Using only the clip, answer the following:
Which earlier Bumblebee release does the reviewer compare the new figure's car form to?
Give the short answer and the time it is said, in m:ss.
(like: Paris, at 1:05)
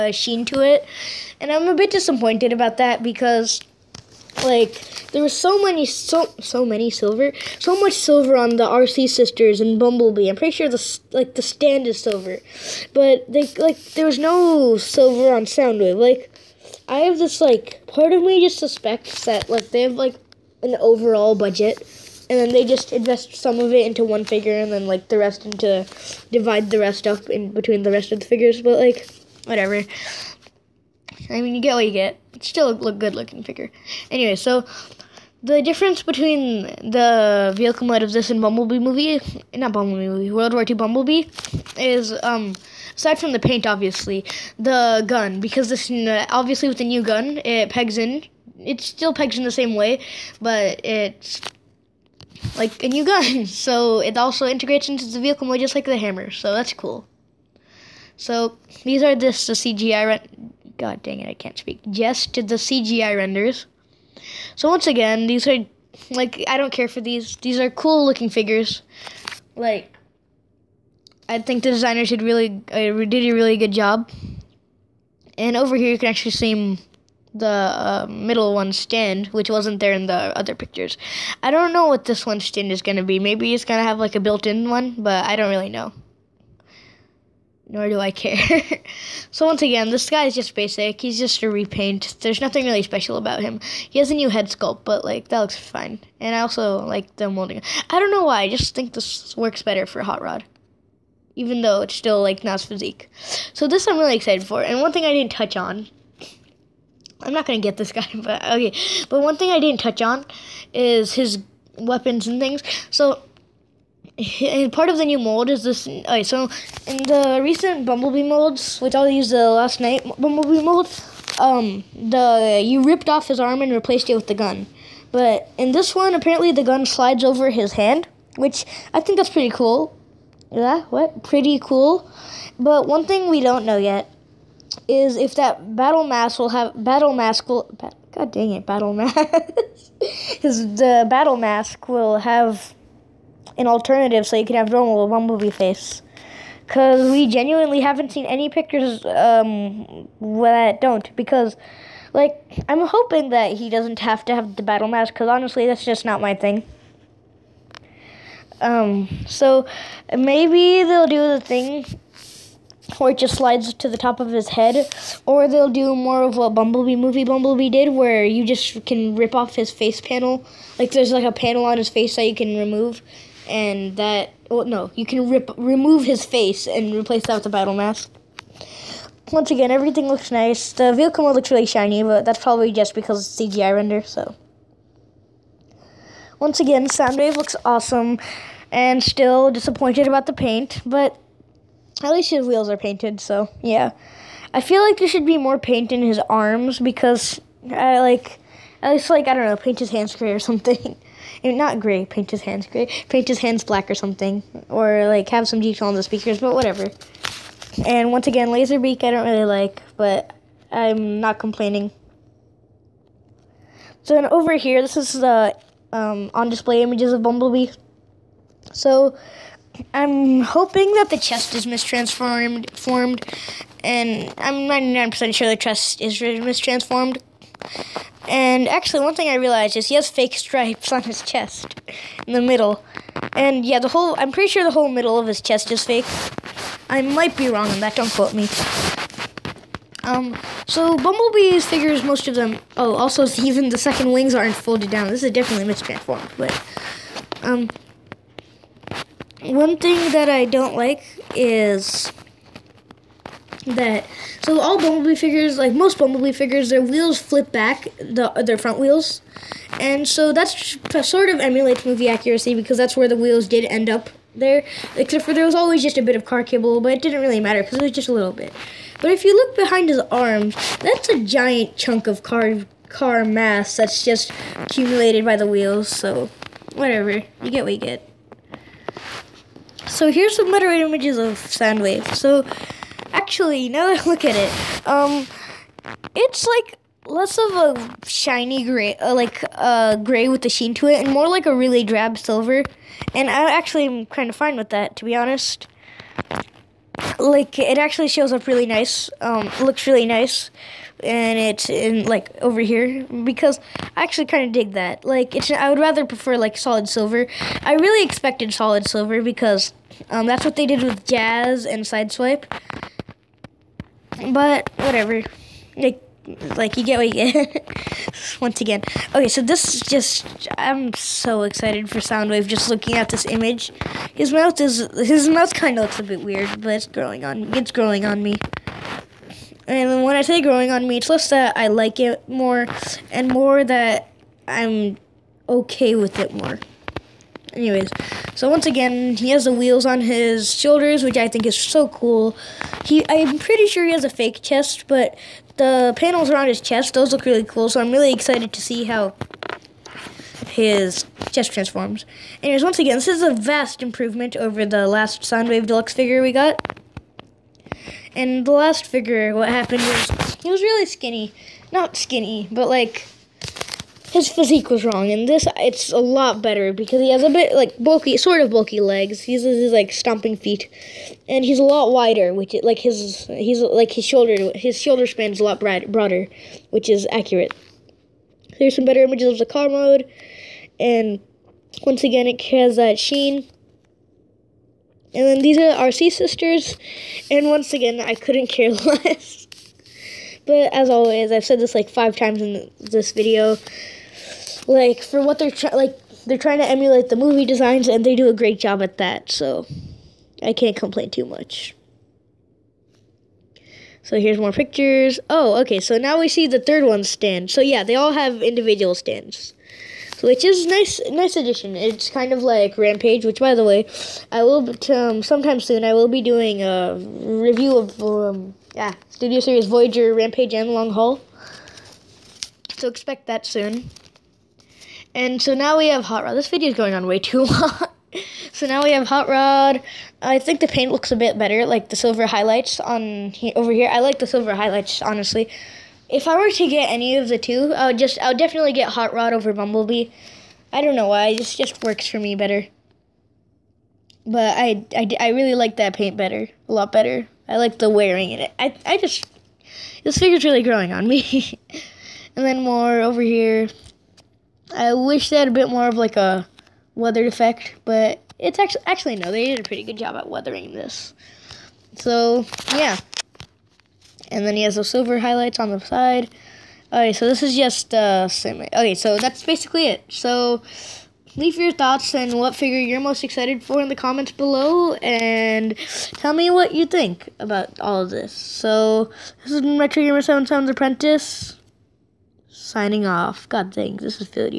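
World War II Bumblebee, at 0:40.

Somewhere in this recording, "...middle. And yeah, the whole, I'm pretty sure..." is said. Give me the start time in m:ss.
3:52.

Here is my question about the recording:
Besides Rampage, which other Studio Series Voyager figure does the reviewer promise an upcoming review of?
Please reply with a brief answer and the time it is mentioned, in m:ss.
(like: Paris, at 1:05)
Long Haul, at 7:00.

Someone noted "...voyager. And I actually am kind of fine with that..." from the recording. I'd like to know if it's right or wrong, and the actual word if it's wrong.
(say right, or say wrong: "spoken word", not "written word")
wrong: "silver", not "voyager".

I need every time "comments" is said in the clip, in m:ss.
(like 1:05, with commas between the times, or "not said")
7:53.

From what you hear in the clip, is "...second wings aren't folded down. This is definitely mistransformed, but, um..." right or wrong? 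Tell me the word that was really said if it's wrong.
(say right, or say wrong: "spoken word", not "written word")
right.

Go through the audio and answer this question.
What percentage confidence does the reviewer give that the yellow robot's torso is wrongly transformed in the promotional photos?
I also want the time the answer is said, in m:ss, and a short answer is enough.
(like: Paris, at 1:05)
99%, at 3:44.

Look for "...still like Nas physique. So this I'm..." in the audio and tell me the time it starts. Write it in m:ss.
1:41.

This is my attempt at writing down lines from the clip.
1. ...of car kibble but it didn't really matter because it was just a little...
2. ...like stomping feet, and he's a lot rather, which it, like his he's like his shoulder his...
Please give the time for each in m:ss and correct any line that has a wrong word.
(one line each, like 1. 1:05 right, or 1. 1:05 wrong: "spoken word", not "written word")
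1. 4:26 right
2. 6:09 wrong: "wider", not "rather".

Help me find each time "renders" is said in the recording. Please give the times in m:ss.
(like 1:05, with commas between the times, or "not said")
1:03, 3:03.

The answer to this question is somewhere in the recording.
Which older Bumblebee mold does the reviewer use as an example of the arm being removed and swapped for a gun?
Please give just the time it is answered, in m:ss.
1:59.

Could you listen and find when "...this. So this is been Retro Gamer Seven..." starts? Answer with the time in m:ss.
7:58.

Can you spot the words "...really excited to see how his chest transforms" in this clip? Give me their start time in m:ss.
5:47.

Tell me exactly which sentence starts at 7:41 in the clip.
So yeah, and then he has those silver highlights on the side.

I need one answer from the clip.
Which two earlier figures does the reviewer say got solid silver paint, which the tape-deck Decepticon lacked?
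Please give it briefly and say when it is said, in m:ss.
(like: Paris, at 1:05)
Jazz and Sideswipe, at 5:11.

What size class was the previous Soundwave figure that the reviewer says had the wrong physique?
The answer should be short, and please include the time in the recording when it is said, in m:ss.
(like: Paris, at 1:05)
Deluxe, at 5:55.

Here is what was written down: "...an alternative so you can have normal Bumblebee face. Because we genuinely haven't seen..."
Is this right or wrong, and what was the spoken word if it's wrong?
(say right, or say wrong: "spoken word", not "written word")
right.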